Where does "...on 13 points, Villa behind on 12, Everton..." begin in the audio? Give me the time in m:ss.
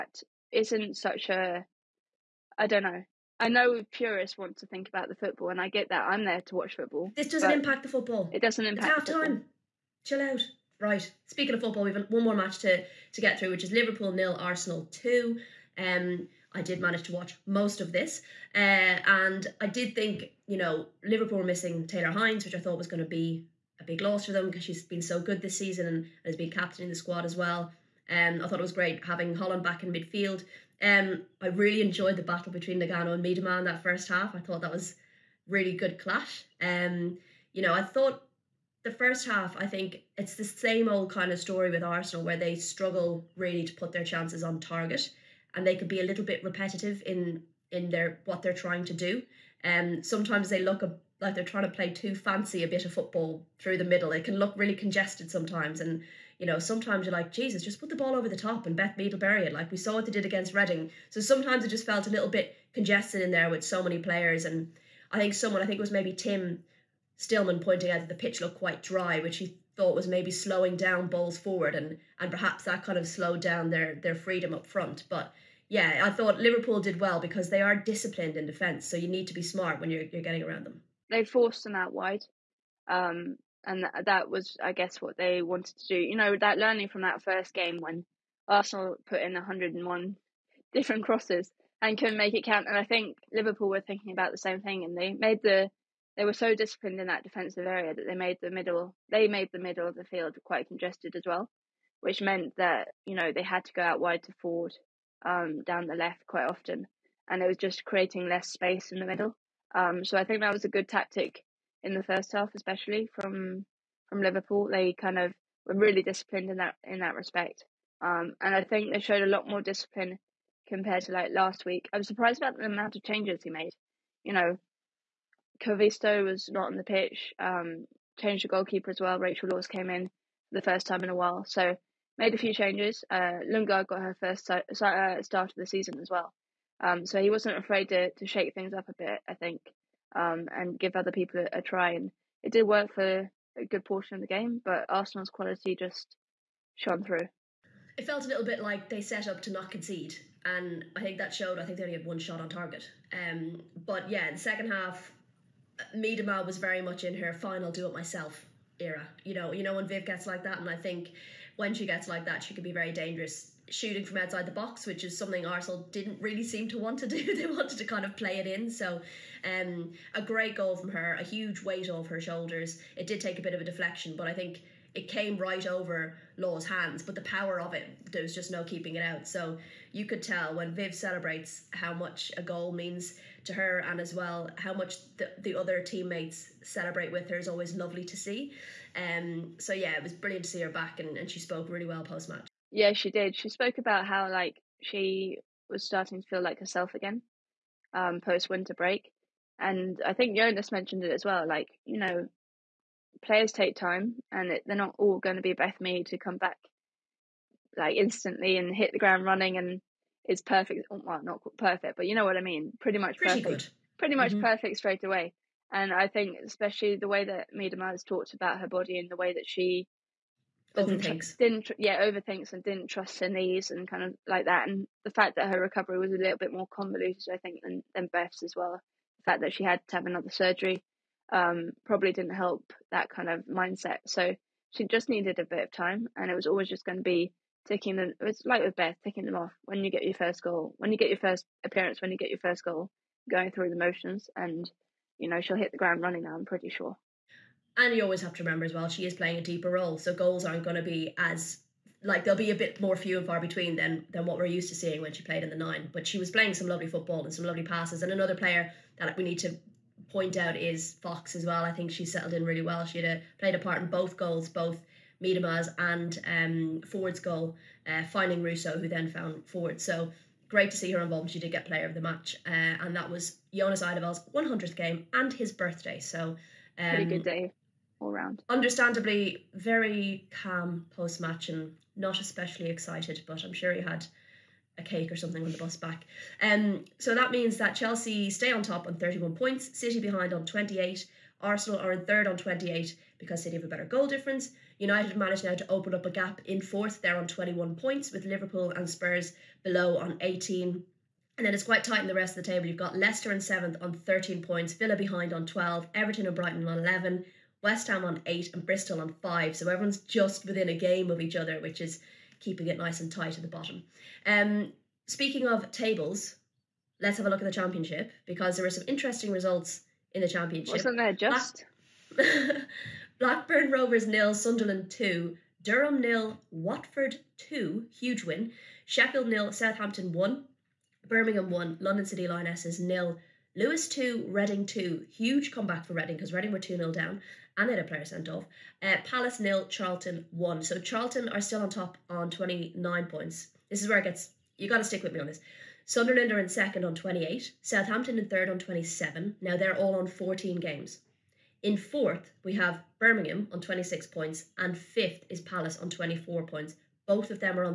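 5:03.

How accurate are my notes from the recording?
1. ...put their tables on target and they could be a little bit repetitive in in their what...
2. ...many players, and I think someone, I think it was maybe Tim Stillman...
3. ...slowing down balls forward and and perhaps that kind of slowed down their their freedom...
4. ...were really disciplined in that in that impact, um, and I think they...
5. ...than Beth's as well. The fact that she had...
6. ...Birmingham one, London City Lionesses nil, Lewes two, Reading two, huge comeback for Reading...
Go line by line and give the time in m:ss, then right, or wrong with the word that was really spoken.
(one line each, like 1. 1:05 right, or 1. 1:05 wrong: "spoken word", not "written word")
1. 0:43 wrong: "chances", not "tables"
2. 1:03 right
3. 1:10 right
4. 1:55 wrong: "respect", not "impact"
5. 3:47 right
6. 5:31 right.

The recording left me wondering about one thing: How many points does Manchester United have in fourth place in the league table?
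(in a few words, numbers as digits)
21.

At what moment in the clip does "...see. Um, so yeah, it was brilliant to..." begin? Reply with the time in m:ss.
3:08.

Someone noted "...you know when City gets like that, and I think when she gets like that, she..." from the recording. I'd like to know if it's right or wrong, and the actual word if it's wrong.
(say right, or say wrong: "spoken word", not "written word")
wrong: "Viv", not "City".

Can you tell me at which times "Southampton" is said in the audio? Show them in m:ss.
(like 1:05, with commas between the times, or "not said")
5:29, 5:47.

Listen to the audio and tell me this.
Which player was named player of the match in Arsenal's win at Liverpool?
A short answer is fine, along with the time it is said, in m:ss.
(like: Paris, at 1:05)
Fox, at 4:21.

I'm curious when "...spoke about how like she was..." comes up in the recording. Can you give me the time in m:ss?
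3:13.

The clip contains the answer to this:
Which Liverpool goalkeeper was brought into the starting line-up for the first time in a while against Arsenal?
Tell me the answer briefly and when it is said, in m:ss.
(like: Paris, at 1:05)
Rachael Laws, at 2:09.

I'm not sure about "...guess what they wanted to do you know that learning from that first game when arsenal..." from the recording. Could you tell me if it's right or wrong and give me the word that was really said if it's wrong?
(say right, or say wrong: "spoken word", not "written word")
right.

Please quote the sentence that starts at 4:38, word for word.
Understandably, very calm post match and not especially excited, but I'm sure he had a cake or something on the bus back.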